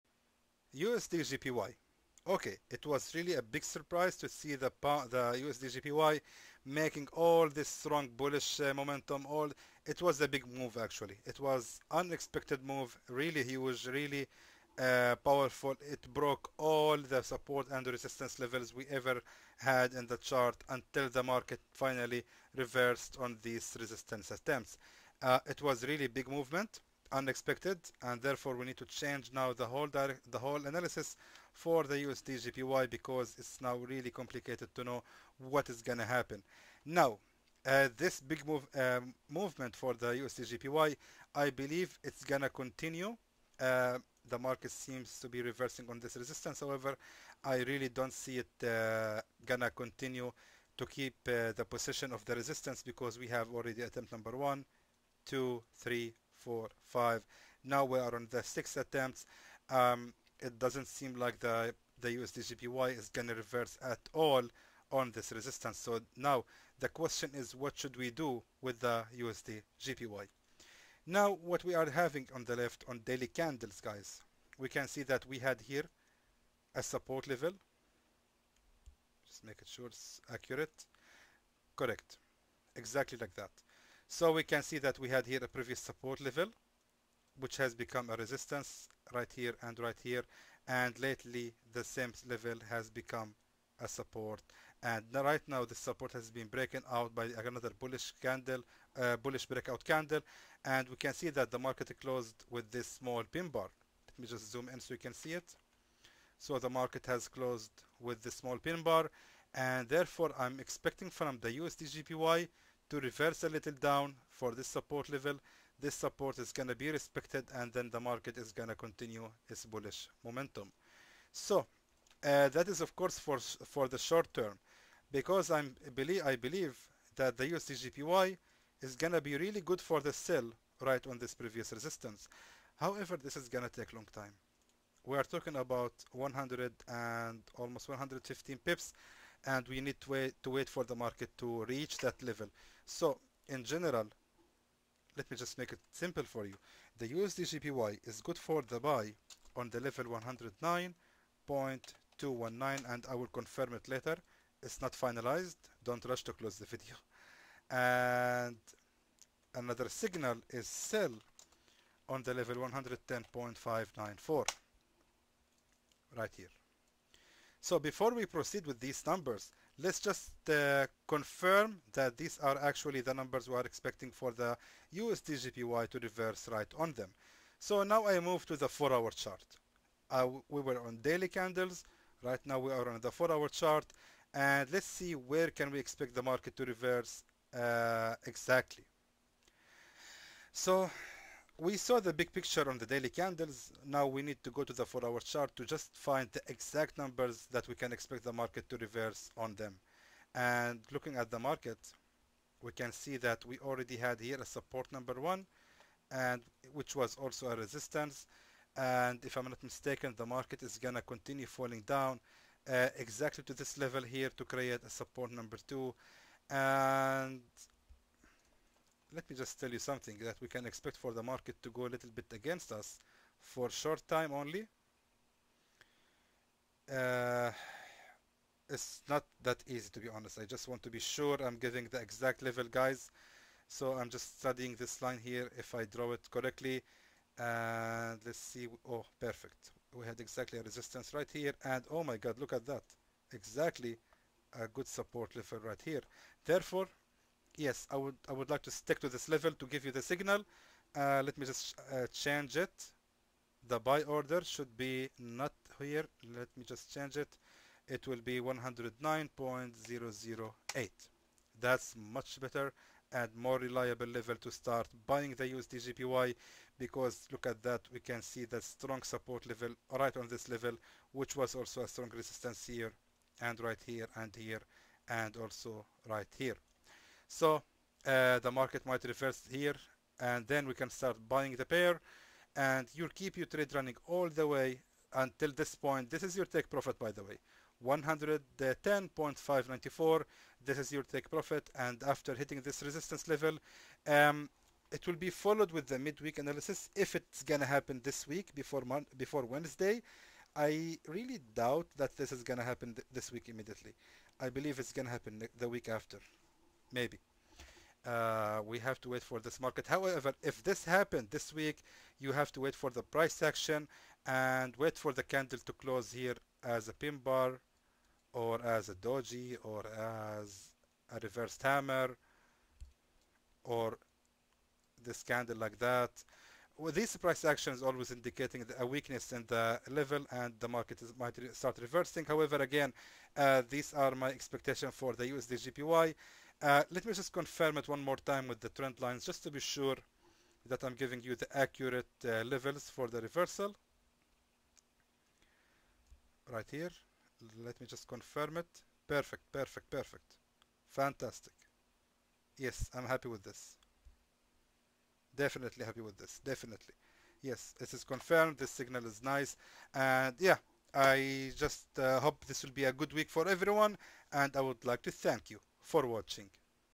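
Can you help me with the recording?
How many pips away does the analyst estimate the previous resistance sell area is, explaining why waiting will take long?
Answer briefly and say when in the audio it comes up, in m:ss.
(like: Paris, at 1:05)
almost 115, at 2:17.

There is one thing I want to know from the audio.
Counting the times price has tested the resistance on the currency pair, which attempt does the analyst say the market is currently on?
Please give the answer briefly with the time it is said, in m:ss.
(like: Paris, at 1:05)
sixth, at 0:58.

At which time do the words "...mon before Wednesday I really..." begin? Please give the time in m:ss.
4:58.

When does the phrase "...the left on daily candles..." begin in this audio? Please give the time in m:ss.
1:12.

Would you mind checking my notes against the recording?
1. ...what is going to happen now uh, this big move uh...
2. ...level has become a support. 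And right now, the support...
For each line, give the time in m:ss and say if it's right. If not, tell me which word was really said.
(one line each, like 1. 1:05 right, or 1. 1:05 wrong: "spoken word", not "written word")
1. 0:35 right
2. 1:32 right.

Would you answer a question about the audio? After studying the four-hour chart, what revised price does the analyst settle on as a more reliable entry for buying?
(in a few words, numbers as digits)
109.008.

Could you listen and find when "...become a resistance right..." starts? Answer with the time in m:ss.
1:27.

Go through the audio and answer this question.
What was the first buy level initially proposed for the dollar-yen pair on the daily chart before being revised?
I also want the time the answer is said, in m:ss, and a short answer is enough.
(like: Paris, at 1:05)
109.219, at 2:30.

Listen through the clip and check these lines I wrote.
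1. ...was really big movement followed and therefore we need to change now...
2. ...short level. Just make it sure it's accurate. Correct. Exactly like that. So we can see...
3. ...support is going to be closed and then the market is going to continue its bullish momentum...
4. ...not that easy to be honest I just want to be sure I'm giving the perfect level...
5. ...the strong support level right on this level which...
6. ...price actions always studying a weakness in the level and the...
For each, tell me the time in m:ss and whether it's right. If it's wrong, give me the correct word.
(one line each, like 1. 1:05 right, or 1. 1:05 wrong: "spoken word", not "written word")
1. 0:25 wrong: "unexpected", not "followed"
2. 1:16 wrong: "support", not "short"
3. 1:55 wrong: "respected", not "closed"
4. 3:49 wrong: "exact", not "perfect"
5. 4:28 right
6. 5:27 wrong: "indicating", not "studying".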